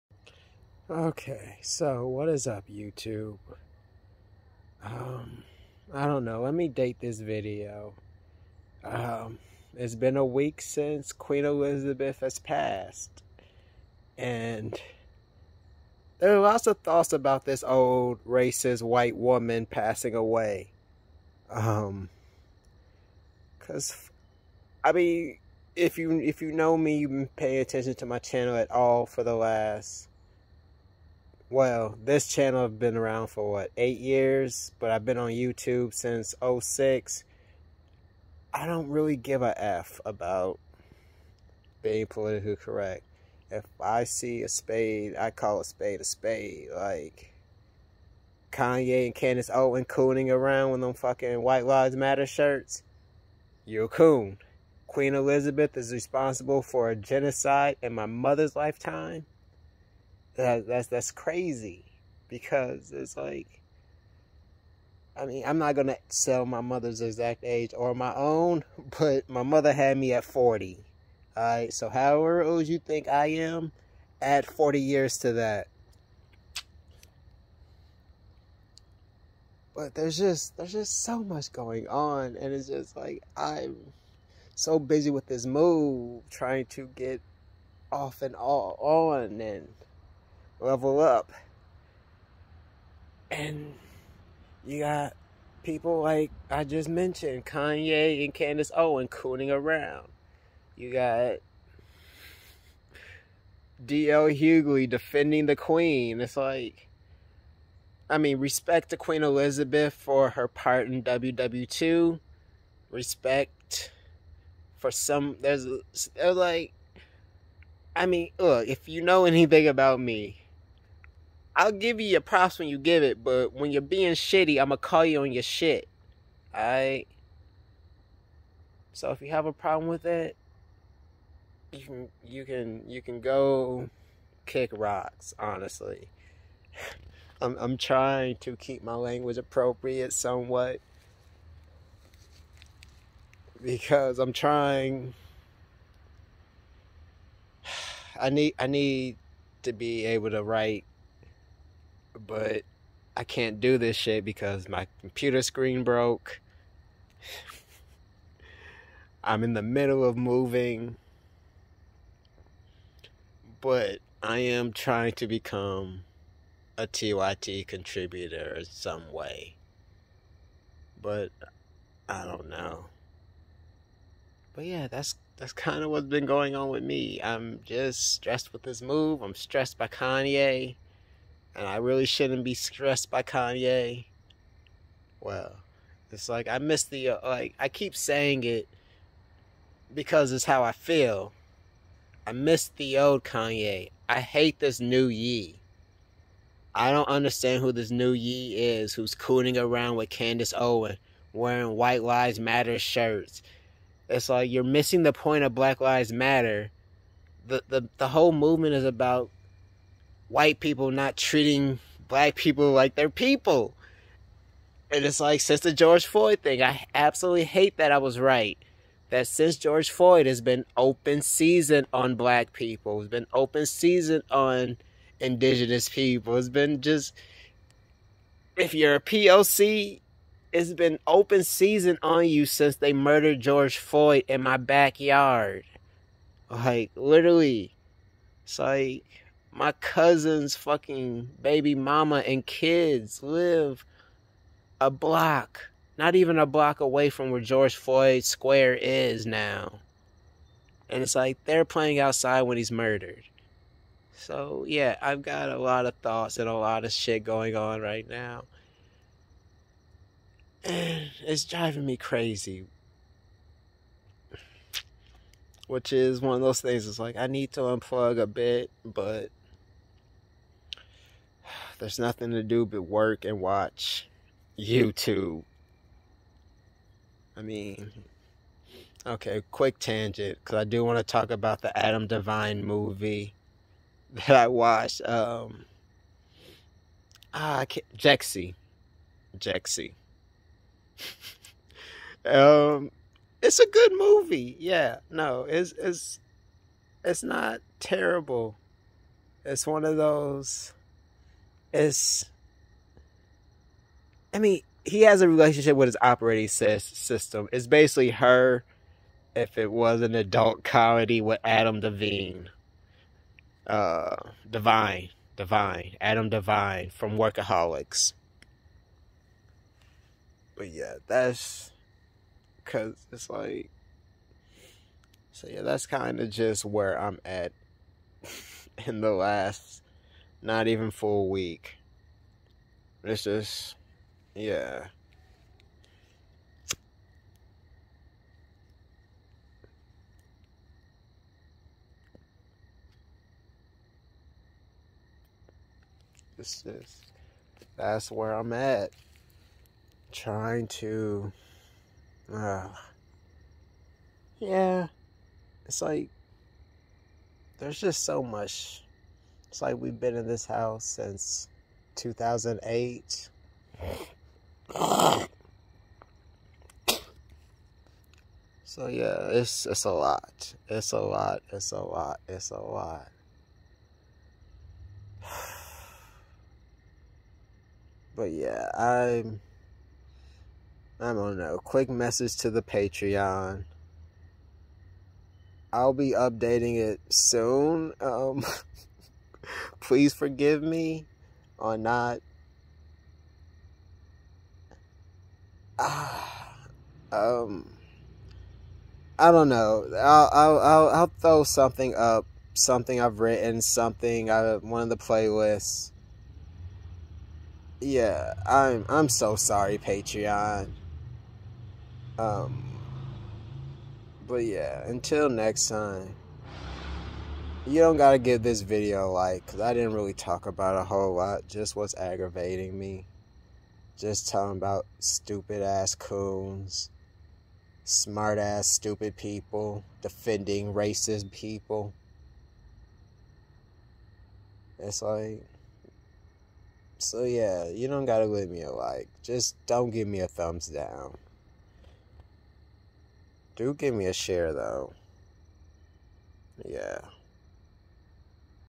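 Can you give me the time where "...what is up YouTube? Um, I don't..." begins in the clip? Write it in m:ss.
0:02.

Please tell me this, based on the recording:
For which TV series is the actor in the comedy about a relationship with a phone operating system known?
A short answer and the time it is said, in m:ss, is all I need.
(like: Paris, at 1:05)
Workaholics, at 5:17.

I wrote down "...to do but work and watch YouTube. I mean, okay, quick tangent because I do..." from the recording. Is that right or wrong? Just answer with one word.
right.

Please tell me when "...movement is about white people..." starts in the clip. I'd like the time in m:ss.
3:28.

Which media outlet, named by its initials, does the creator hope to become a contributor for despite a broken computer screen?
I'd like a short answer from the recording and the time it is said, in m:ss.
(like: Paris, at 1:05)
TYT, at 2:46.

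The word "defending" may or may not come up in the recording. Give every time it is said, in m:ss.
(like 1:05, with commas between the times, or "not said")
1:44, 7:10.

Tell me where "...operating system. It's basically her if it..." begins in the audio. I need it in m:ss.
5:06.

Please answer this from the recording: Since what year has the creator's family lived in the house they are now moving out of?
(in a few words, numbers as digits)
2008.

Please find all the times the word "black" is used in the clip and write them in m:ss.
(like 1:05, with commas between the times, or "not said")
3:25, 3:32, 3:42.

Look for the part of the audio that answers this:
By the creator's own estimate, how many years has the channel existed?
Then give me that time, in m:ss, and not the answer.
0:33.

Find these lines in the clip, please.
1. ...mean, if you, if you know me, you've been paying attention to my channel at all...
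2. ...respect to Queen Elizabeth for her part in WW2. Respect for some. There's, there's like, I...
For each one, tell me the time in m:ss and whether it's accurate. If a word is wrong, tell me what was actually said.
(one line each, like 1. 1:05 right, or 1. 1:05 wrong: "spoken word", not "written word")
1. 0:24 right
2. 1:48 right.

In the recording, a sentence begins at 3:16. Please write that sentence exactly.
I don't understand who this new Ye is who's cooning around with Candace Owen wearing White Lives Matter shirts.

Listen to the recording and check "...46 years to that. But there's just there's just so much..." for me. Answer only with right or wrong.
wrong.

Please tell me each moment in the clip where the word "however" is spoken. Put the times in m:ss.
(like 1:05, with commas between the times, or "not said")
1:11.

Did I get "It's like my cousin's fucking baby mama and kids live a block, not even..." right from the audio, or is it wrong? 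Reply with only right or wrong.
right.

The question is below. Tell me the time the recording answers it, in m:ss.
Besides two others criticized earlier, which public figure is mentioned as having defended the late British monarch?
1:43.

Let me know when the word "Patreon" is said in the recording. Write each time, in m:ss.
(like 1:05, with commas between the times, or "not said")
6:22, 6:49.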